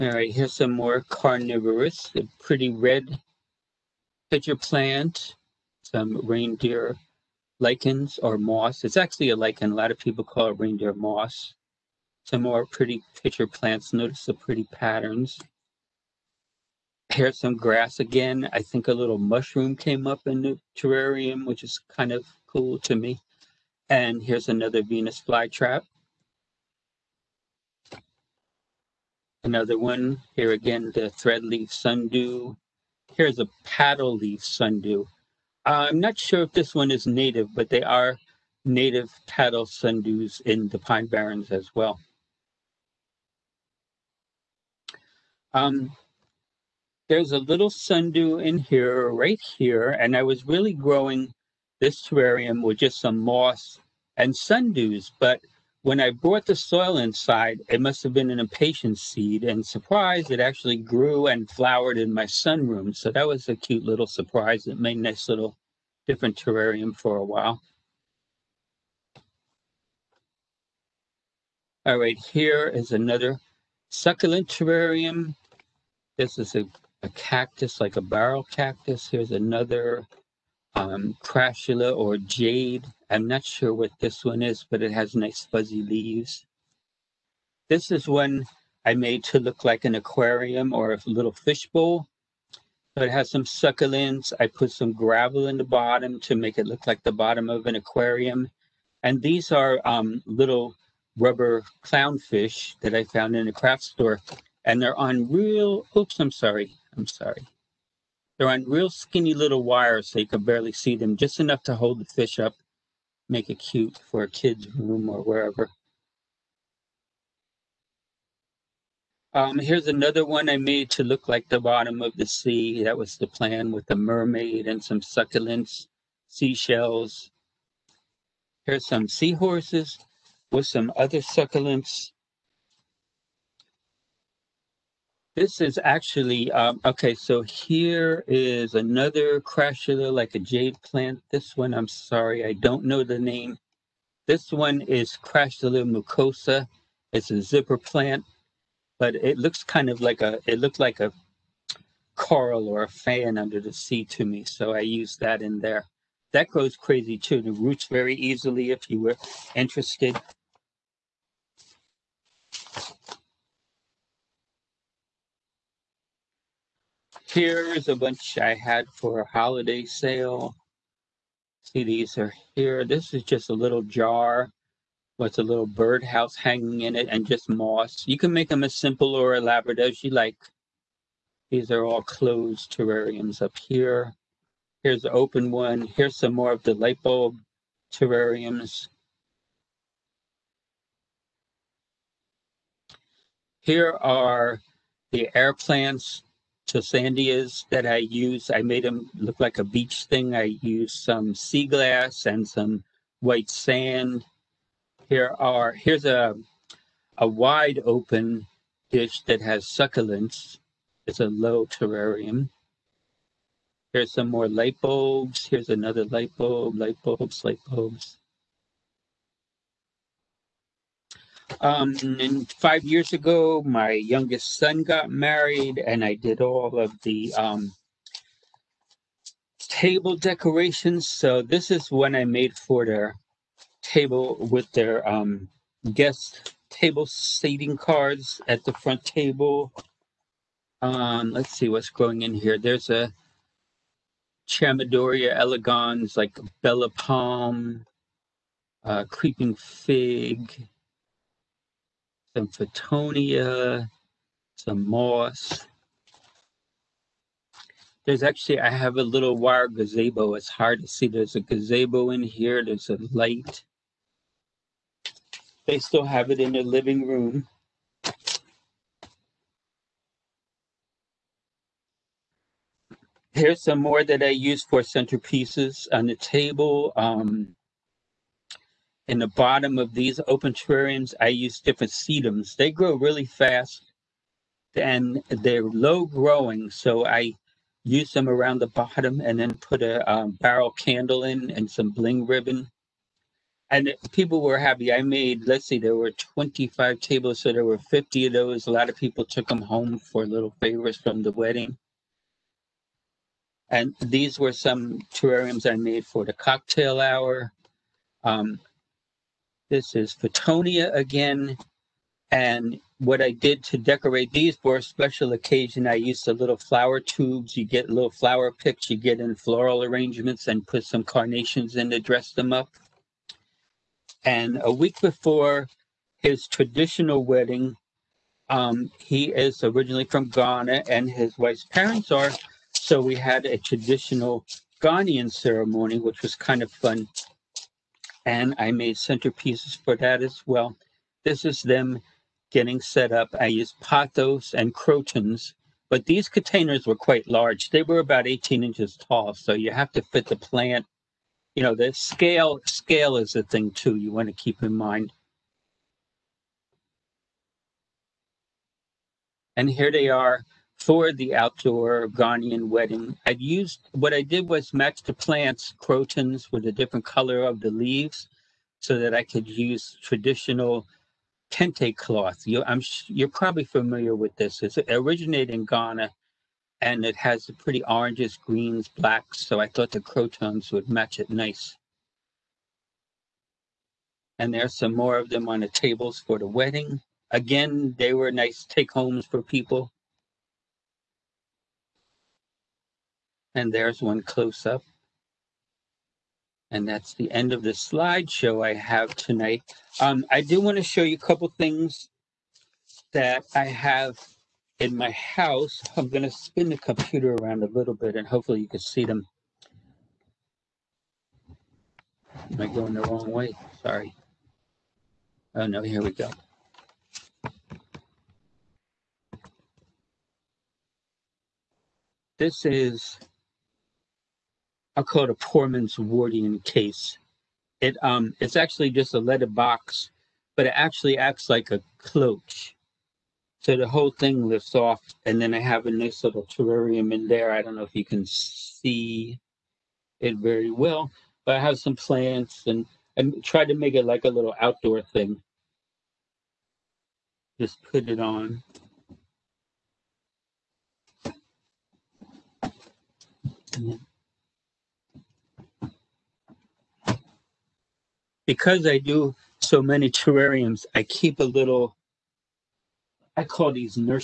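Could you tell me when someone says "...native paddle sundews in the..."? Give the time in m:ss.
0:38.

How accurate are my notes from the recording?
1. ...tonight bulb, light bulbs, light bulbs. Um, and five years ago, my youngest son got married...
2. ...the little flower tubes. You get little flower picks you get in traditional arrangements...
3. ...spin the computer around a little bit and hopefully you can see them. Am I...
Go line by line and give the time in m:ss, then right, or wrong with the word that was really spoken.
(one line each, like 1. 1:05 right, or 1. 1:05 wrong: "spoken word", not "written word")
1. 3:36 wrong: "light", not "tonight"
2. 5:16 wrong: "floral", not "traditional"
3. 6:46 right.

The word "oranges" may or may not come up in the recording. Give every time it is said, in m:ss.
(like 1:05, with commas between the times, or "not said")
6:17.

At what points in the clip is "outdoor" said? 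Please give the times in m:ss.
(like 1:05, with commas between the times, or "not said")
6:01, 7:24.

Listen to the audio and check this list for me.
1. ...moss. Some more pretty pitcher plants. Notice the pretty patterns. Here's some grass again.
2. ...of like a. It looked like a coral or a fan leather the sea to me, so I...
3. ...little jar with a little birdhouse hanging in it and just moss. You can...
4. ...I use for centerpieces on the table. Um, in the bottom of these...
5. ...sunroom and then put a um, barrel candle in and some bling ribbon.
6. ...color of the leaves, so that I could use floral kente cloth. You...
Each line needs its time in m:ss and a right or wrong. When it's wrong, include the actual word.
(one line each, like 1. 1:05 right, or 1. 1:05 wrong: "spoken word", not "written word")
1. 0:10 right
2. 2:29 wrong: "under", not "leather"
3. 2:53 right
4. 4:34 right
5. 4:48 wrong: "bottom", not "sunroom"
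6. 6:07 wrong: "traditional", not "floral".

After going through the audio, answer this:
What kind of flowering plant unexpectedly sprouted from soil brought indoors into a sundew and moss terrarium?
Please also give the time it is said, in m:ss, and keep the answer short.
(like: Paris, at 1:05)
Impatiens, at 0:58.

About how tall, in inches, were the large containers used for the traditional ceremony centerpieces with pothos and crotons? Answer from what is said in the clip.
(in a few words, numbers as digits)
18 inches.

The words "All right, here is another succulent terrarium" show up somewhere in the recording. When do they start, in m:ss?
1:11.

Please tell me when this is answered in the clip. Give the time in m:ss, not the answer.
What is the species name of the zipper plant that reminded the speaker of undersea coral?
2:25.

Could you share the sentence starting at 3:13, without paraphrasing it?
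Here are the air plants Tillandsias that I used.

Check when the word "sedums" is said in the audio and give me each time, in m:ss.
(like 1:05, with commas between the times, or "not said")
4:41.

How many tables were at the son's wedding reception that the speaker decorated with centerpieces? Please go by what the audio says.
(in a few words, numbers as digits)
25.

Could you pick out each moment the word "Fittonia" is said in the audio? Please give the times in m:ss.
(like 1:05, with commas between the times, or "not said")
4:12, 5:10.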